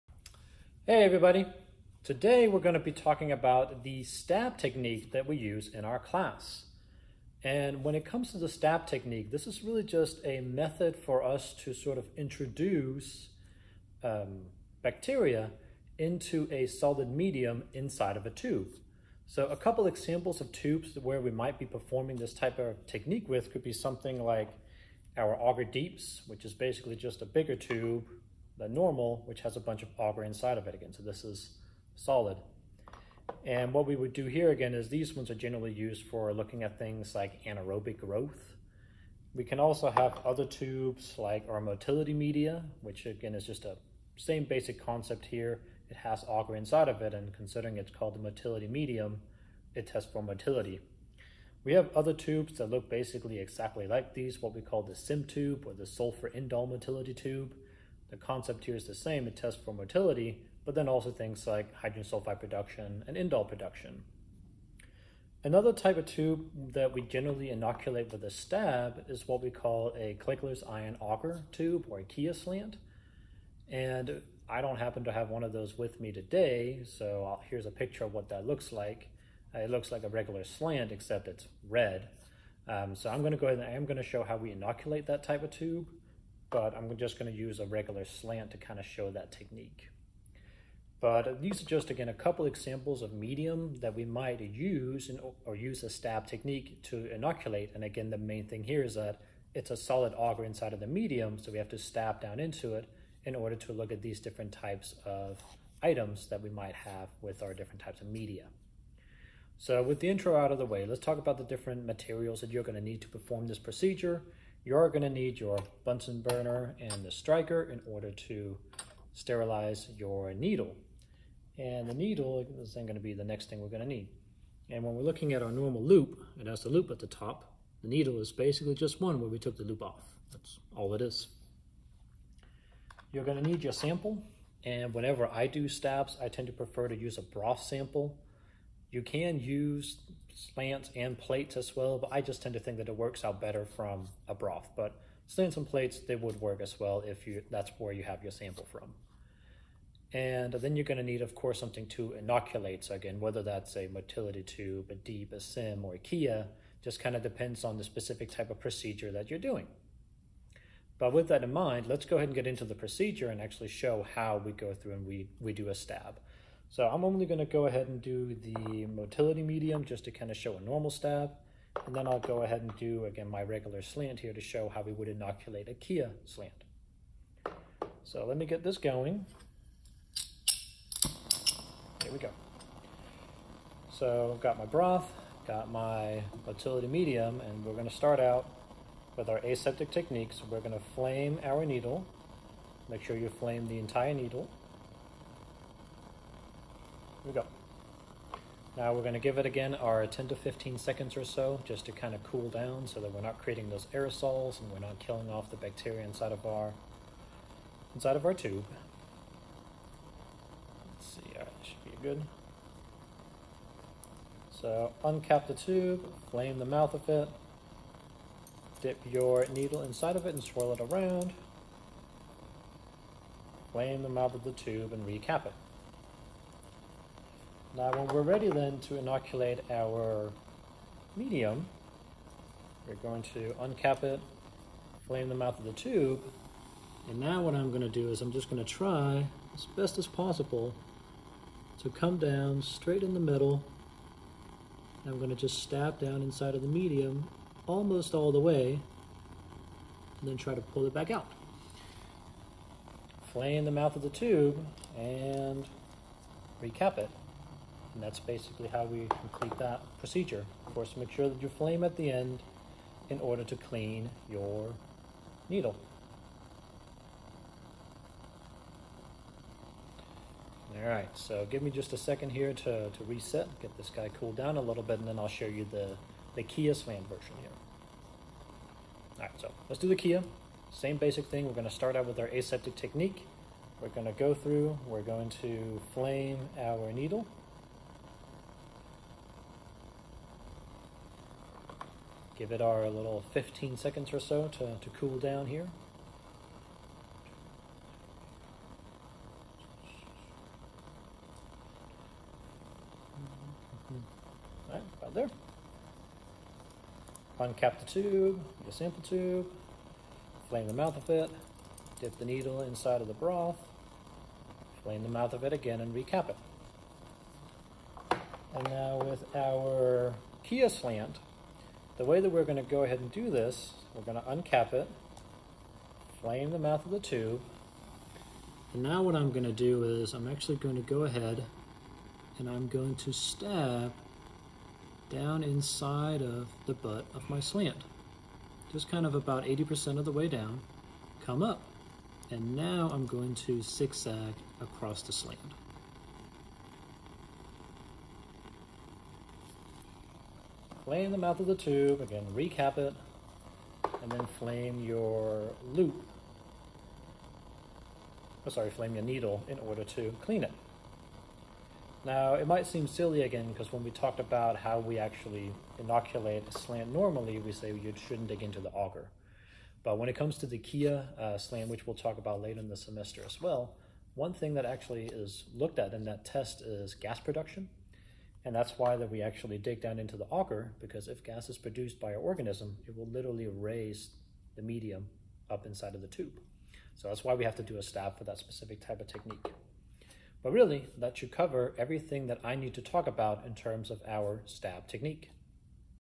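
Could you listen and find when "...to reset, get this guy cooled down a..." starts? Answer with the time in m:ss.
4:32.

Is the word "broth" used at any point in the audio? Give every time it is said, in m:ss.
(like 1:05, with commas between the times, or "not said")
2:17, 2:24, 3:04, 5:13.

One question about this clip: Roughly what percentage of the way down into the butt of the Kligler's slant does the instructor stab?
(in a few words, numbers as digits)
80%.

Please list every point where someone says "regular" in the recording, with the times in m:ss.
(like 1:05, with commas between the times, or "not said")
1:20, 1:27, 2:53.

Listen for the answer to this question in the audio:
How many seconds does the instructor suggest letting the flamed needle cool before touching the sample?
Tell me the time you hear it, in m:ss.
3:20.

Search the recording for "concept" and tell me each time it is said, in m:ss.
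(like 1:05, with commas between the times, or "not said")
0:44, 0:58.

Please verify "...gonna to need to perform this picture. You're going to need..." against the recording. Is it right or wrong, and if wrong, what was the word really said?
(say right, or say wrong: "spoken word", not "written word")
wrong: "procedure", not "picture".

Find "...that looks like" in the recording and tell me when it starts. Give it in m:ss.
1:18.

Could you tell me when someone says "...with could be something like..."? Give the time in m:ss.
0:23.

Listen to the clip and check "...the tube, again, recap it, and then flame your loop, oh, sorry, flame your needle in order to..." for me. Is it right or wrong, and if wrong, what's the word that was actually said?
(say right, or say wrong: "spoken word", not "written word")
right.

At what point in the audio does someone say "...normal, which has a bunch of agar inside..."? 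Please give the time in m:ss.
0:28.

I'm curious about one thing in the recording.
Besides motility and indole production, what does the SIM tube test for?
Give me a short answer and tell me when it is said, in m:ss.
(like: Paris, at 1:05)
Hydrogen sulfide production, at 1:01.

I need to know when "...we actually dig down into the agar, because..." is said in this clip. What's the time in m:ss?
6:19.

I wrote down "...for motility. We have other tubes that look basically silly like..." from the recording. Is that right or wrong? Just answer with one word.
wrong.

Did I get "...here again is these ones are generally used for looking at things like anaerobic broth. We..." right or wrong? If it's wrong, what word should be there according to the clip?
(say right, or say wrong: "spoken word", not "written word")
wrong: "growth", not "broth".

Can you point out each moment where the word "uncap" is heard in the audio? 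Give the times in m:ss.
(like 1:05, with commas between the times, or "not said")
3:35, 3:53, 5:07, 5:24.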